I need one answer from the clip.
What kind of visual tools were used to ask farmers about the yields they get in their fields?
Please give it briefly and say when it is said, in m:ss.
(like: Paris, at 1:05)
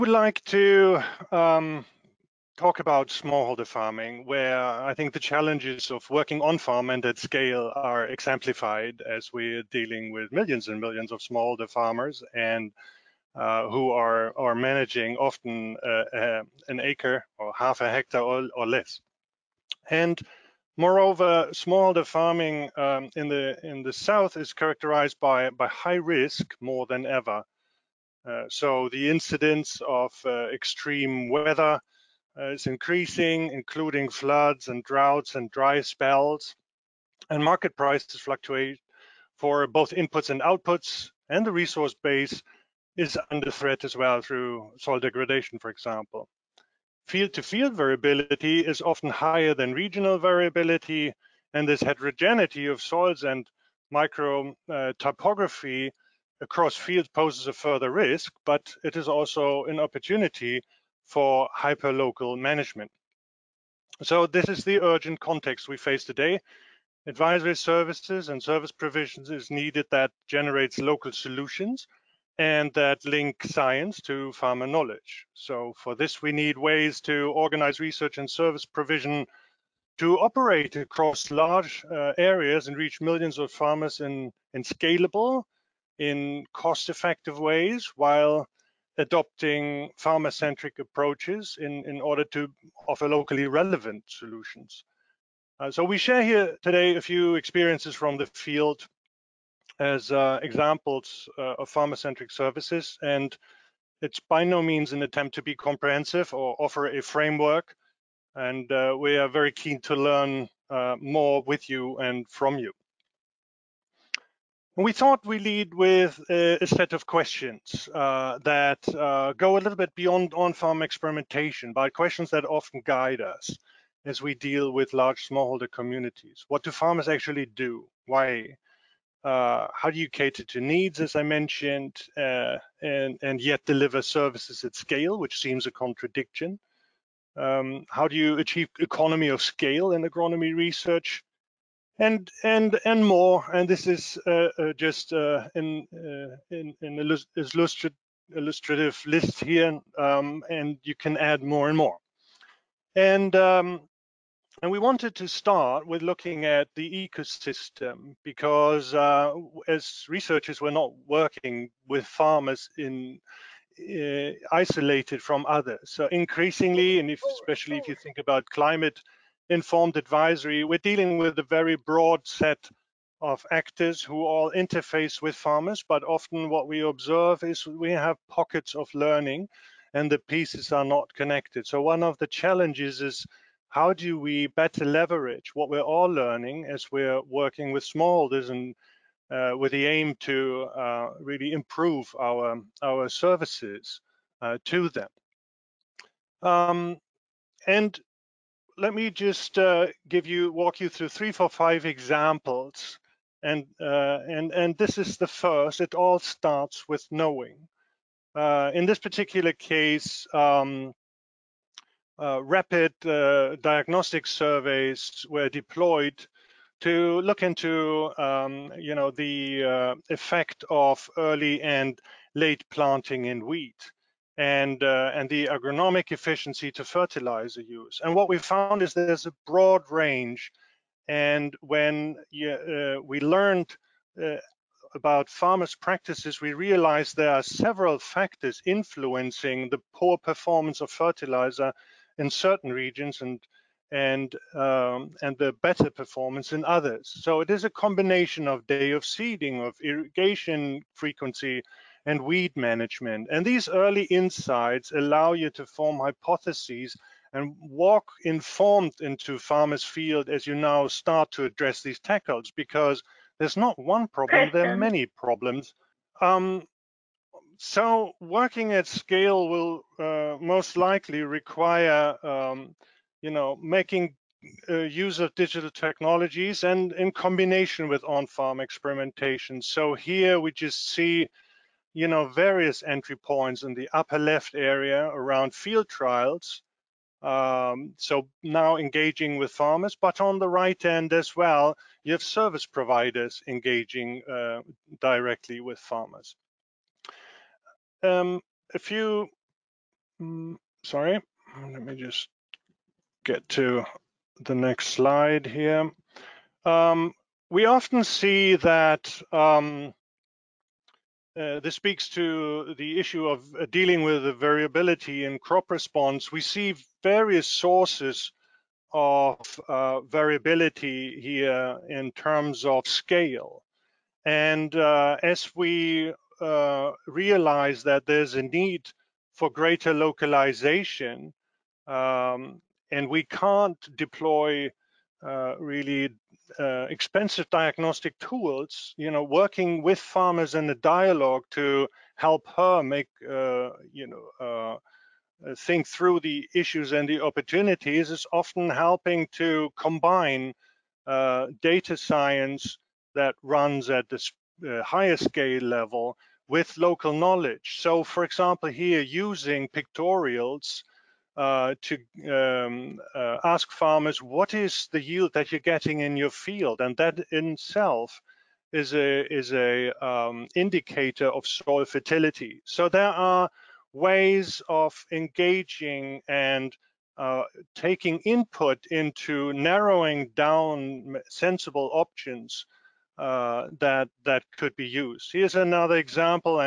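pictorials, at 5:59.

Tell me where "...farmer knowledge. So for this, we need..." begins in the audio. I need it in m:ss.
1:14.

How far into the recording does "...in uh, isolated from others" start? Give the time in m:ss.
2:42.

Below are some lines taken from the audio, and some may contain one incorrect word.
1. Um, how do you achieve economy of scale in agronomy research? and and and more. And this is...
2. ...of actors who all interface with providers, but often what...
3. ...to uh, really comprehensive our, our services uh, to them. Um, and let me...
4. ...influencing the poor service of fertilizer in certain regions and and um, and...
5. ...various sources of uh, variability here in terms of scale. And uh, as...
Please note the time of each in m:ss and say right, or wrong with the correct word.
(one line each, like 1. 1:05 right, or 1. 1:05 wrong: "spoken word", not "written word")
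1. 2:17 right
2. 2:53 wrong: "farmers", not "providers"
3. 3:10 wrong: "improve", not "comprehensive"
4. 3:58 wrong: "performance", not "service"
5. 5:17 right.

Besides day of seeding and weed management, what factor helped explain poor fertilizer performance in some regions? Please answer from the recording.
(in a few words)
irrigation frequency.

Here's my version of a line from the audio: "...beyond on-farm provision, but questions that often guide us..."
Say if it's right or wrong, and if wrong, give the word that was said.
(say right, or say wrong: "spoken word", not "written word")
wrong: "experimentation", not "provision".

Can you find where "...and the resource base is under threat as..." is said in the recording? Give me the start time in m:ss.
0:41.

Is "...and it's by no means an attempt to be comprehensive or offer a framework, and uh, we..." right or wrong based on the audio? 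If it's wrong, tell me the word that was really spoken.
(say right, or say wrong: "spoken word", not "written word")
right.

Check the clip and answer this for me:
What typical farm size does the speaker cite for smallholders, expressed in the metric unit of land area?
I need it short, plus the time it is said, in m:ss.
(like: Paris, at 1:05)
half a hectare, at 0:17.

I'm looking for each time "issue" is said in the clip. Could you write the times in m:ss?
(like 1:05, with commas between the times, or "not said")
5:12, 5:46.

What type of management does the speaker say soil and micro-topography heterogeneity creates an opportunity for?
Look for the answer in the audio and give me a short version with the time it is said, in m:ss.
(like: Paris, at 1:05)
hyperlocal management, at 1:01.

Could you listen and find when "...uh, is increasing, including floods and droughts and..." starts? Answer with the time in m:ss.
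0:32.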